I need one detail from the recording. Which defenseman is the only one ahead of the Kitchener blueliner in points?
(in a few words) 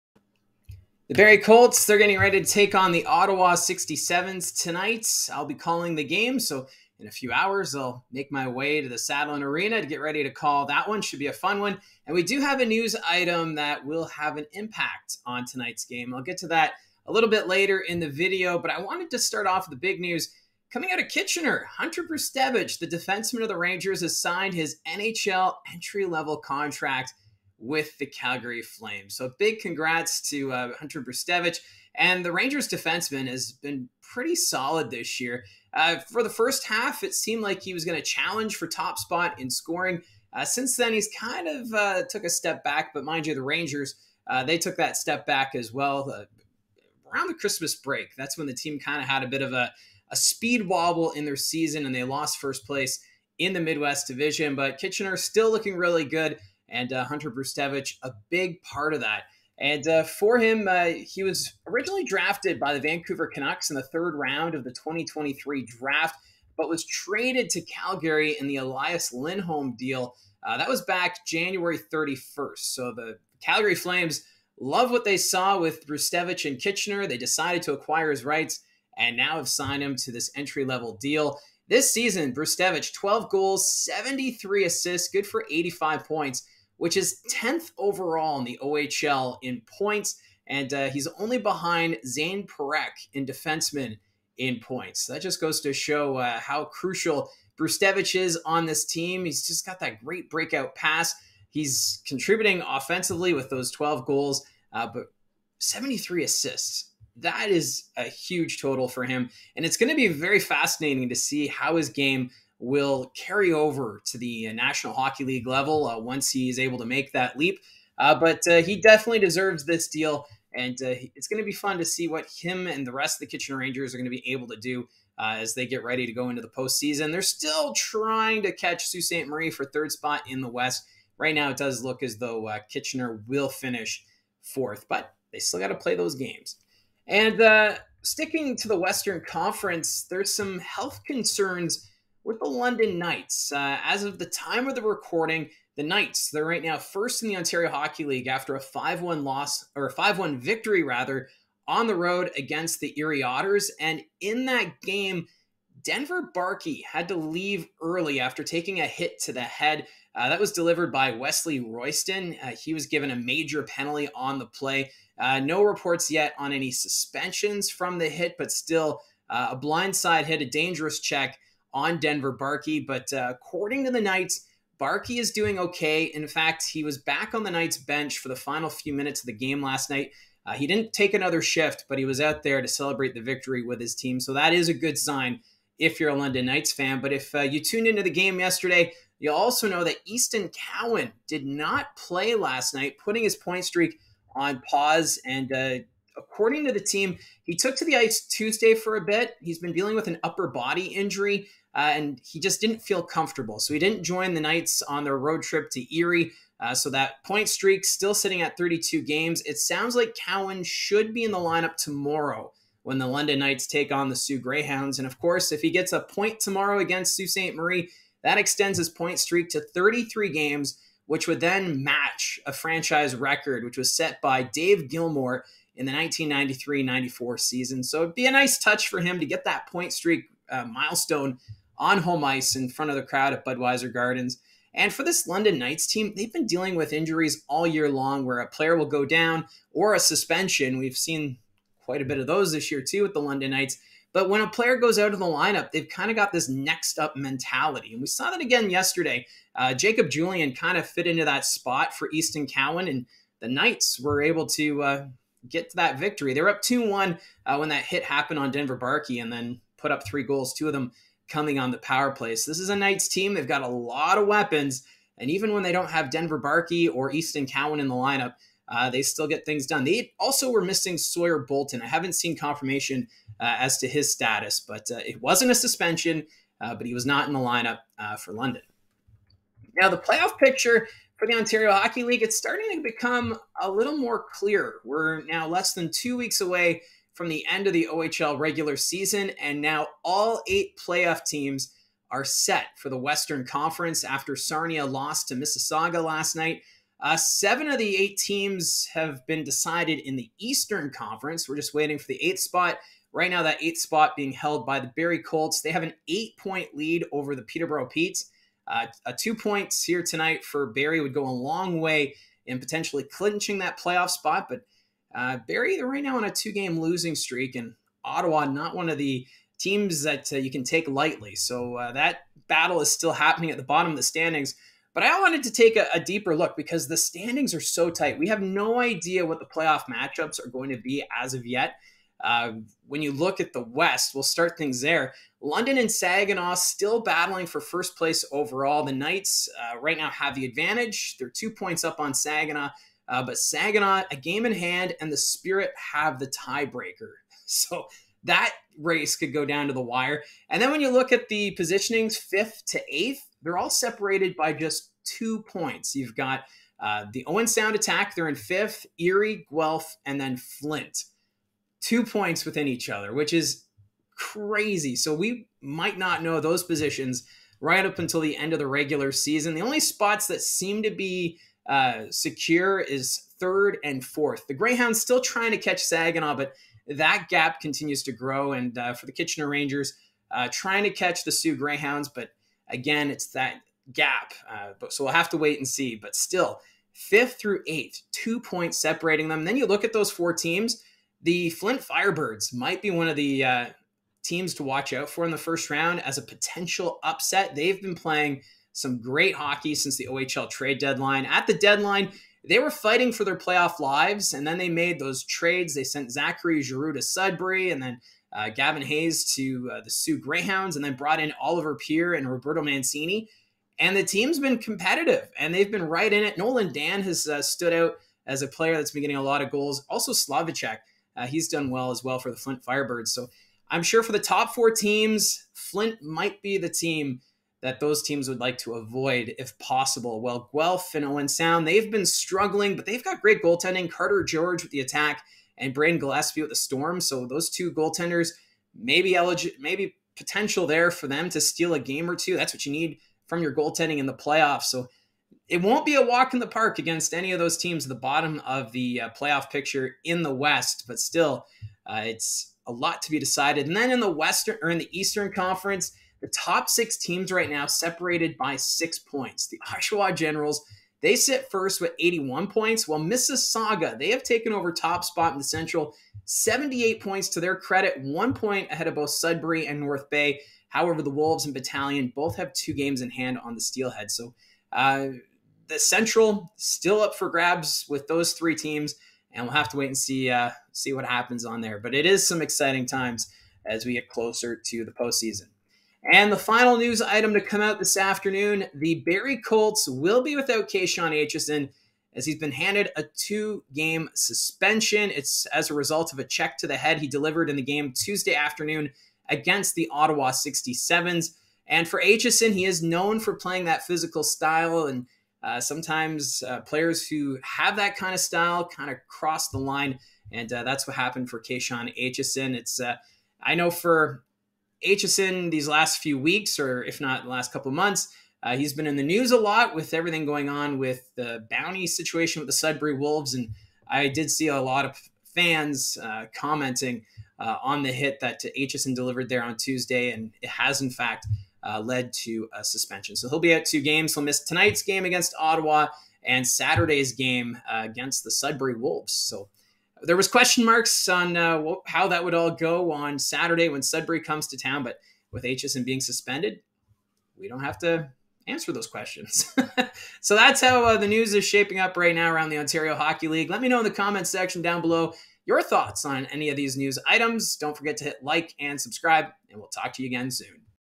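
Zane Parekh.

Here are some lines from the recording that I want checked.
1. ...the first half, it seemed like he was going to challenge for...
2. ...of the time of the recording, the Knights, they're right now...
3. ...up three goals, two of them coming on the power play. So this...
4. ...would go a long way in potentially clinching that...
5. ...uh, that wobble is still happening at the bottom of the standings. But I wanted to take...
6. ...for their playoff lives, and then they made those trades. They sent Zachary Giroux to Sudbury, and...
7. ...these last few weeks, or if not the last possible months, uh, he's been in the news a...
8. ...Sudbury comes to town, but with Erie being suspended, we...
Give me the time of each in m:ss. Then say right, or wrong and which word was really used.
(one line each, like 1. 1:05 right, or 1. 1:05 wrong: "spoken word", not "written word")
1. 0:36 right
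2. 2:24 right
3. 4:19 right
4. 5:11 right
5. 5:21 wrong: "battle", not "wobble"
6. 6:43 right
7. 8:35 wrong: "couple", not "possible"
8. 9:03 wrong: "Aitcheson", not "Erie".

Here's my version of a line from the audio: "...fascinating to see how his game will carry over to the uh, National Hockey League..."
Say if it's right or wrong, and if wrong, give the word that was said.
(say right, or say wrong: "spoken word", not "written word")
right.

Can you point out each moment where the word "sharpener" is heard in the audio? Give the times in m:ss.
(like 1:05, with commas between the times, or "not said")
not said.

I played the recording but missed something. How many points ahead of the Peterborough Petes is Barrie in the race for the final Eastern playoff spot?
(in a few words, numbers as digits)
8.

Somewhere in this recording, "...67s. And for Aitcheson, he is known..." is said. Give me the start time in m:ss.
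8:20.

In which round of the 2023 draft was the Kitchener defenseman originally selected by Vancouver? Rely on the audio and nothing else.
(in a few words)
third round.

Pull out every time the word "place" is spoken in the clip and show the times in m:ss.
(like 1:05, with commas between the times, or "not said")
0:52, 5:37.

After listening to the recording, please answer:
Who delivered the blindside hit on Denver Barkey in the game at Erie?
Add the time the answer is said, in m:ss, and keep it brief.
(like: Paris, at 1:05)
Wesley Royston, at 2:41.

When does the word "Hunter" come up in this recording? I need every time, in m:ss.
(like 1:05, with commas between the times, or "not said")
0:21, 0:30, 0:57.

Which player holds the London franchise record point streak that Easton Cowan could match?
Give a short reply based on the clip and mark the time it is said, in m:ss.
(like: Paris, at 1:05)
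Dave Gilmore, at 3:44.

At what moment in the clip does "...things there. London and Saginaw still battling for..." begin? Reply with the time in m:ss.
5:34.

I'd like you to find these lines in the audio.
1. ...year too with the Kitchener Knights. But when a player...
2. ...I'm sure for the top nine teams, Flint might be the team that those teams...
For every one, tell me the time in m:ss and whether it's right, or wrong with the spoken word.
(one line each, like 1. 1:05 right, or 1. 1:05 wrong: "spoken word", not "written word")
1. 4:02 wrong: "London", not "Kitchener"
2. 7:03 wrong: "four", not "nine".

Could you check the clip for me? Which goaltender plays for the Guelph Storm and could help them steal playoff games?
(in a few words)
Brandon Gillespie.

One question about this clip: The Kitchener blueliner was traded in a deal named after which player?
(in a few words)
Elias Lindholm.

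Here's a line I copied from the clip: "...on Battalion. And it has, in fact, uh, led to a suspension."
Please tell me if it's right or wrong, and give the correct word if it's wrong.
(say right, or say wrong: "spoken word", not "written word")
wrong: "Tuesday", not "Battalion".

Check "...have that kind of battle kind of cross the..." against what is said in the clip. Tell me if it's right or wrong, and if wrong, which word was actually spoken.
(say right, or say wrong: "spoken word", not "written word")
wrong: "style", not "battle".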